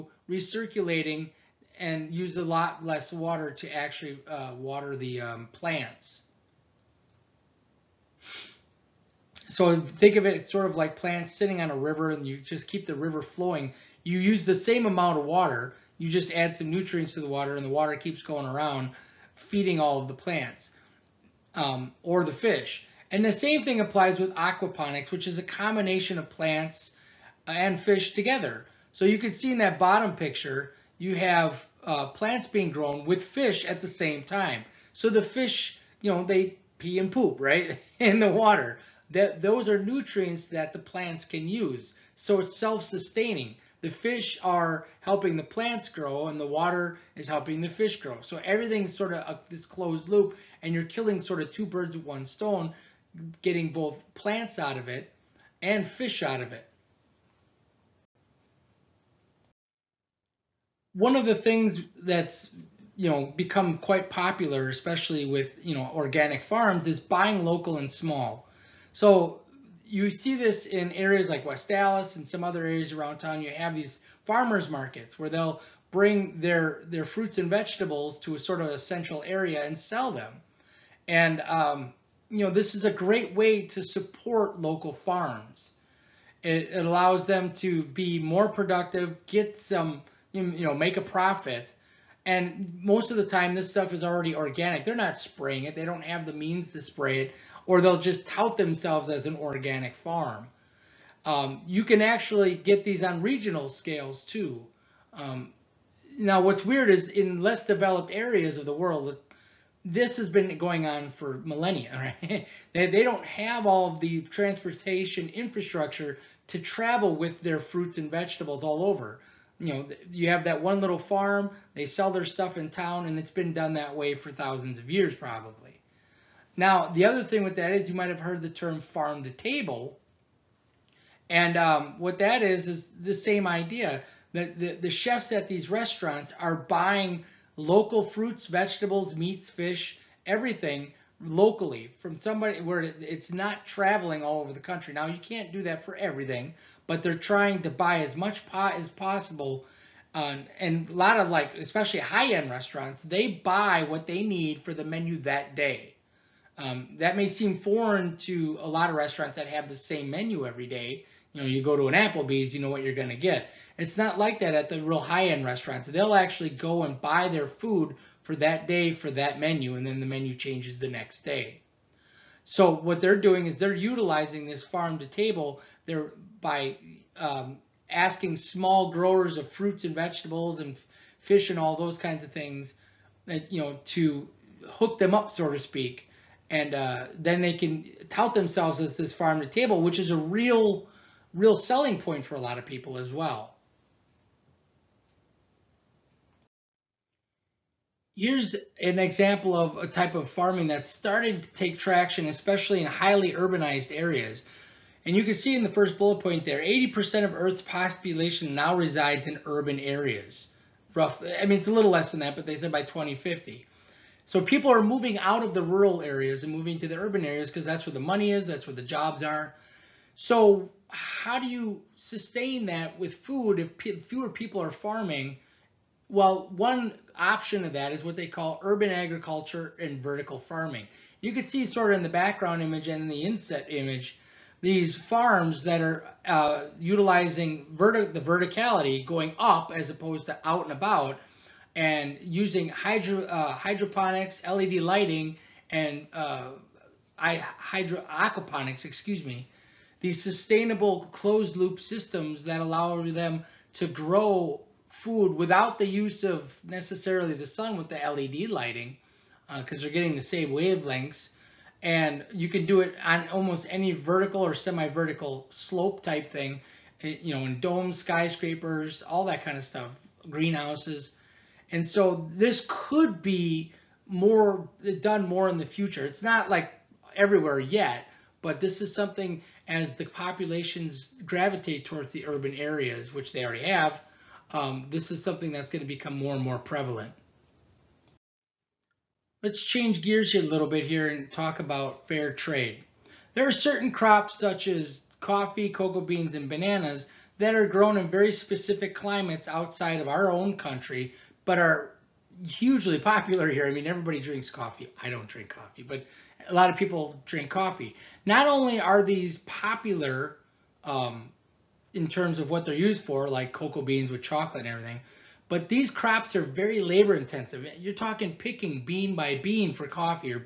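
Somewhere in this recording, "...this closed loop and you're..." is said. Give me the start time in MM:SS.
00:49.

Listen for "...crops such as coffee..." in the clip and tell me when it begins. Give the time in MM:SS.
04:53.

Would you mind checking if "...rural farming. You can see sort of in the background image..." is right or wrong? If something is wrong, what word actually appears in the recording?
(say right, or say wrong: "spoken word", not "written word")
wrong: "vertical", not "rural".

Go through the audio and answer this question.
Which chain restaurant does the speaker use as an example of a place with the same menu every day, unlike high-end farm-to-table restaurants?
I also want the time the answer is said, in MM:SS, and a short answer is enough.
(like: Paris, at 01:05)
Applebee's, at 02:41.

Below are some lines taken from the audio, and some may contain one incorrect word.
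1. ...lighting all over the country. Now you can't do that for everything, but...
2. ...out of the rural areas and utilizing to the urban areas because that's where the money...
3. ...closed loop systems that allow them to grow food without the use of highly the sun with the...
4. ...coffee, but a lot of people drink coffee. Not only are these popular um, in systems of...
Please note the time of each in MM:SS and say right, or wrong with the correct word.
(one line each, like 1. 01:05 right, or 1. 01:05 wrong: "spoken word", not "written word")
1. 02:23 wrong: "traveling", not "lighting"
2. 03:35 wrong: "moving", not "utilizing"
3. 04:11 wrong: "necessarily", not "highly"
4. 05:05 wrong: "terms", not "systems".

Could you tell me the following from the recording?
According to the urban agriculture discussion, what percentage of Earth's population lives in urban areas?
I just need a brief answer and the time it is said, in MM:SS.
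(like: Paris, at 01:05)
80%, at 03:26.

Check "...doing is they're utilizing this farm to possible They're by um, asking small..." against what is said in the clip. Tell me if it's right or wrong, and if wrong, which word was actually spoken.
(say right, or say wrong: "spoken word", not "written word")
wrong: "table", not "possible".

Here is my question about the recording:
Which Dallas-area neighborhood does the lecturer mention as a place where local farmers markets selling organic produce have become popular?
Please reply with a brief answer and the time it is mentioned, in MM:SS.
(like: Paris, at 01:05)
West Dallas, at 01:11.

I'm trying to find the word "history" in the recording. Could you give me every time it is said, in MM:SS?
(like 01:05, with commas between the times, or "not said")
not said.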